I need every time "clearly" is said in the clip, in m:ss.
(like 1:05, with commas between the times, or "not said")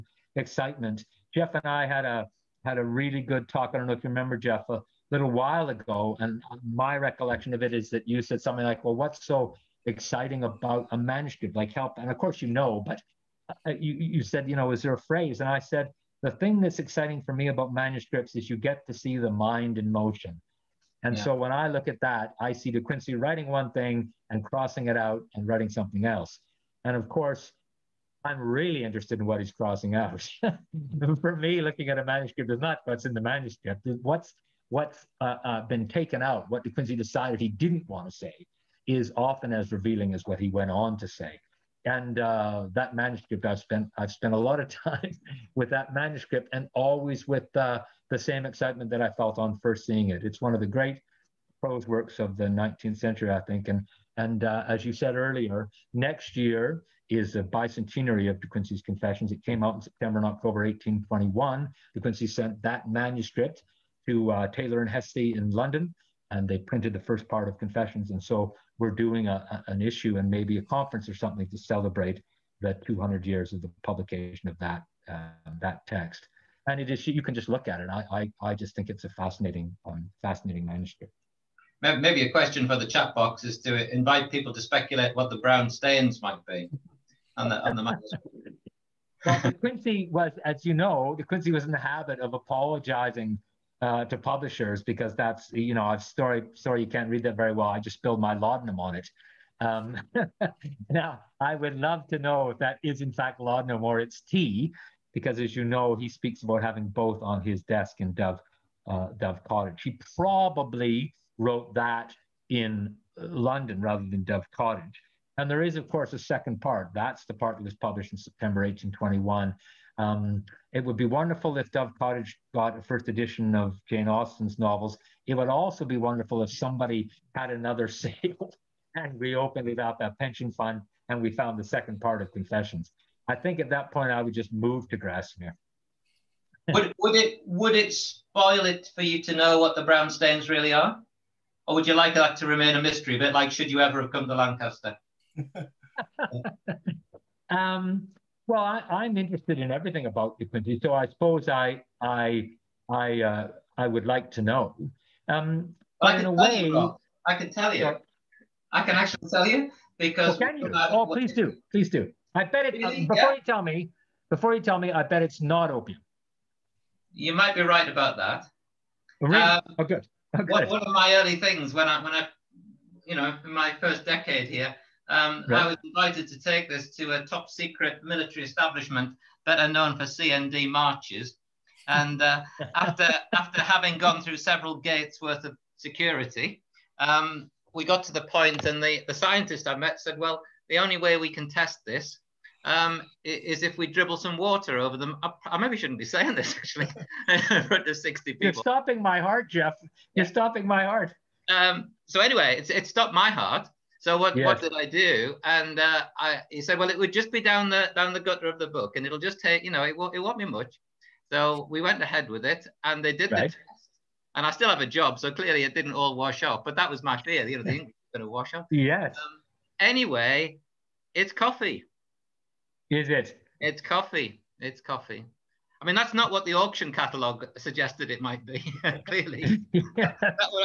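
3:35, 3:49.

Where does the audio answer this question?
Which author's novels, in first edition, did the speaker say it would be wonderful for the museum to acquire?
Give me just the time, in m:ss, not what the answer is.
2:03.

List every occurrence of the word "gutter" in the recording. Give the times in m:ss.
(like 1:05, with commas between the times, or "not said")
3:28.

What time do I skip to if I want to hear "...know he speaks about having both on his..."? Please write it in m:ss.
1:45.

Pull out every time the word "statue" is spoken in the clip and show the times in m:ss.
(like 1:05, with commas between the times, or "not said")
not said.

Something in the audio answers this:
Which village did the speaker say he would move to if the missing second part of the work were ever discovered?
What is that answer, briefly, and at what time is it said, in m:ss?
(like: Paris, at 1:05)
Grasmere, at 2:14.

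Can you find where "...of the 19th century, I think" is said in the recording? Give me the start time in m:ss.
0:52.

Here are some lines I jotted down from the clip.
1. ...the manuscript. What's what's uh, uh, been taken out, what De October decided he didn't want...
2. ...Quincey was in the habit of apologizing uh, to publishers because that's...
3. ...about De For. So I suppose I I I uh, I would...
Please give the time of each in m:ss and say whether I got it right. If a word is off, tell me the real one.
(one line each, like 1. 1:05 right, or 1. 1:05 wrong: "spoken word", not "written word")
1. 0:33 wrong: "Quincey", not "October"
2. 1:31 right
3. 2:30 wrong: "Quincey", not "For".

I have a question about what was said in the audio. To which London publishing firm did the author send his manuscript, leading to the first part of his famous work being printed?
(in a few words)
Taylor and Hessey.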